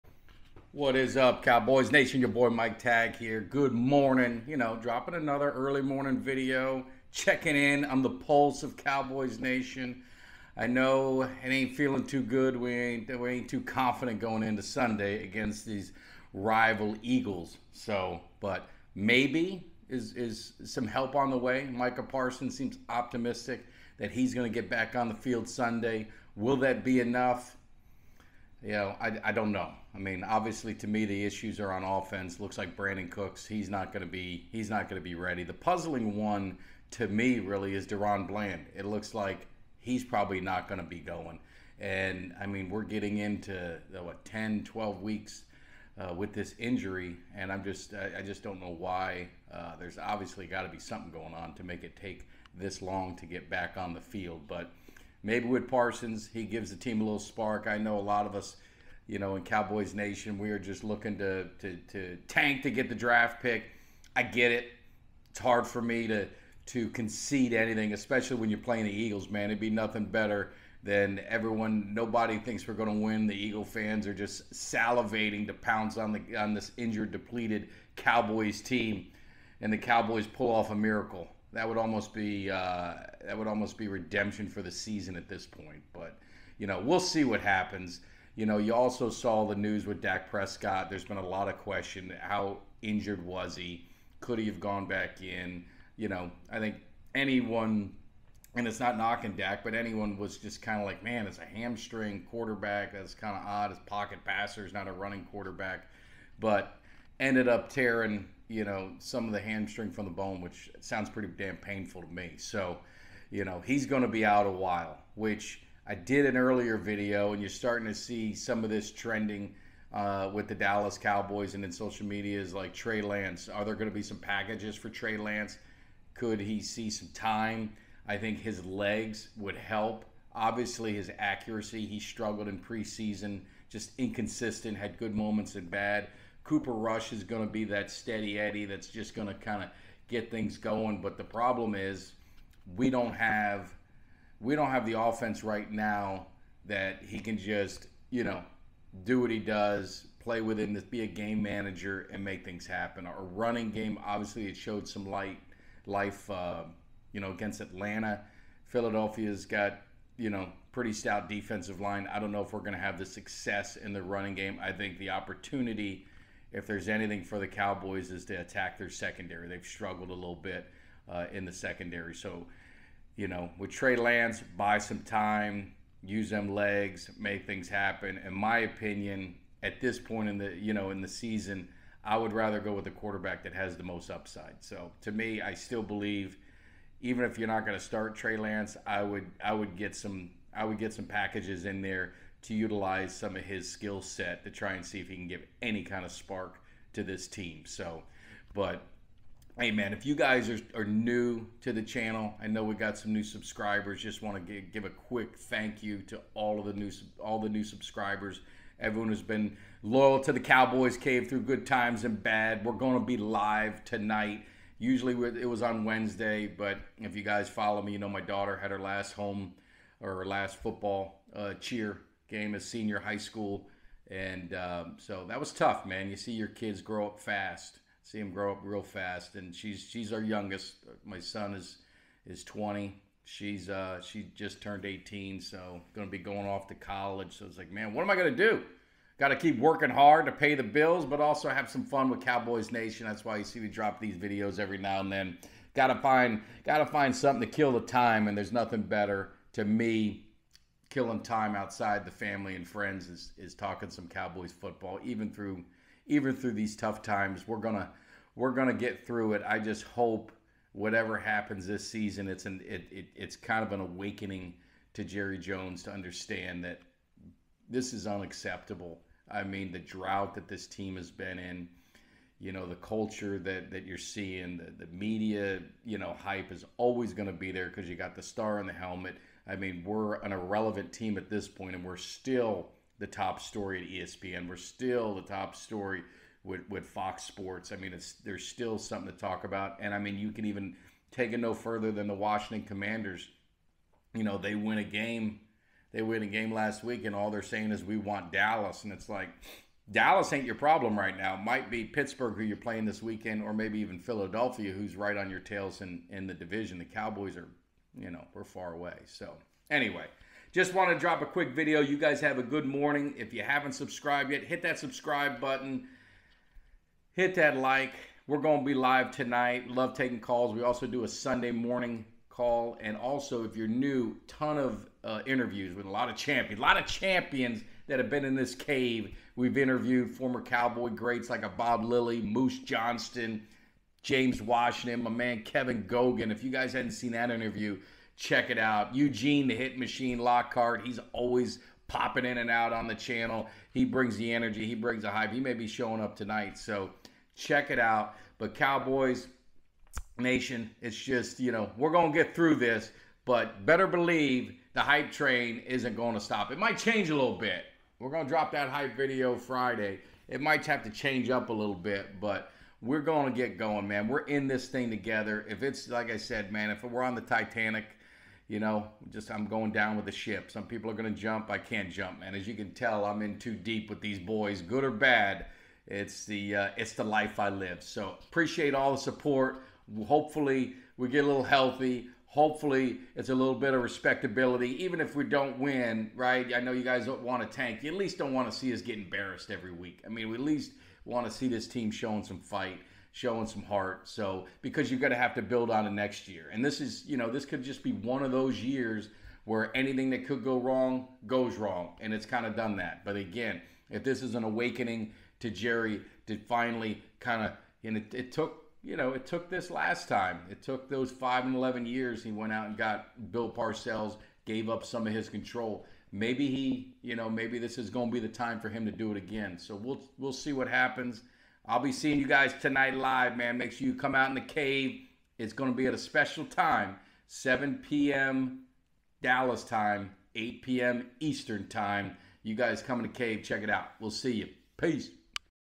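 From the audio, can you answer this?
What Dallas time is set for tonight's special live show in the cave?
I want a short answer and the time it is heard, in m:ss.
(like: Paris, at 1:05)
7 p.m., at 7:07.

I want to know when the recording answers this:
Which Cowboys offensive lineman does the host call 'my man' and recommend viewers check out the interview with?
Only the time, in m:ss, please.
5:35.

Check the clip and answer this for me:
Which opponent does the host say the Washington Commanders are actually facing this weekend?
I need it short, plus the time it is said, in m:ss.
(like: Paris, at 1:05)
Pittsburgh, at 5:01.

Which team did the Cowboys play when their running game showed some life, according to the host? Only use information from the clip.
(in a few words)
Atlanta.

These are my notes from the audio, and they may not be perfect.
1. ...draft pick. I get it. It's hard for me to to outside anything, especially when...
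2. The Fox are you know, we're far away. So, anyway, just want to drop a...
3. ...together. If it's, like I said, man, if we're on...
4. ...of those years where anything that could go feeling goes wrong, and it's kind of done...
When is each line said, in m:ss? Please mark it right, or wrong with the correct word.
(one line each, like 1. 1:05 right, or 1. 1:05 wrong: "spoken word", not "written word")
1. 1:02 wrong: "concede", not "outside"
2. 5:06 wrong: "Cowboys", not "Fox"
3. 6:04 right
4. 6:38 wrong: "wrong", not "feeling".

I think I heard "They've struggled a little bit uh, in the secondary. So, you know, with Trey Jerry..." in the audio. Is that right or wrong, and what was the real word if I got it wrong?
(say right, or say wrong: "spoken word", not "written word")
wrong: "Lance", not "Jerry".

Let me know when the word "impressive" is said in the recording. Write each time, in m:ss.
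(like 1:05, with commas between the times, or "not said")
not said.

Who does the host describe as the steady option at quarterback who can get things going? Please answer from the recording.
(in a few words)
Cooper Rush.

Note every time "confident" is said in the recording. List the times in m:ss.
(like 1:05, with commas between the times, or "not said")
0:13.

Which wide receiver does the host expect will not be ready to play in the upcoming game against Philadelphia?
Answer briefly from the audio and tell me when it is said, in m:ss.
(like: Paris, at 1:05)
Brandin Cooks, at 0:32.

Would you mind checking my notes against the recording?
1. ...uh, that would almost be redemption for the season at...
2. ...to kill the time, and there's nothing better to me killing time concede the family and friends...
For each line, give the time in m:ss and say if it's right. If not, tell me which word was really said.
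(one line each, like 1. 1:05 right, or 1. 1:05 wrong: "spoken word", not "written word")
1. 1:22 right
2. 4:07 wrong: "outside", not "concede".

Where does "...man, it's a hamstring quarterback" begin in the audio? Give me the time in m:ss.
1:41.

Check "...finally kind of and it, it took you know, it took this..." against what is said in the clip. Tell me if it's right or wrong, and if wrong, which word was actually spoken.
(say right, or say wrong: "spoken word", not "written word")
right.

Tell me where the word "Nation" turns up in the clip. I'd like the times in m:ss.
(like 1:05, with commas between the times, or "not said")
0:01, 0:09, 0:59, 4:02, 5:50.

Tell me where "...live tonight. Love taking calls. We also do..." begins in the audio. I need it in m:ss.
5:18.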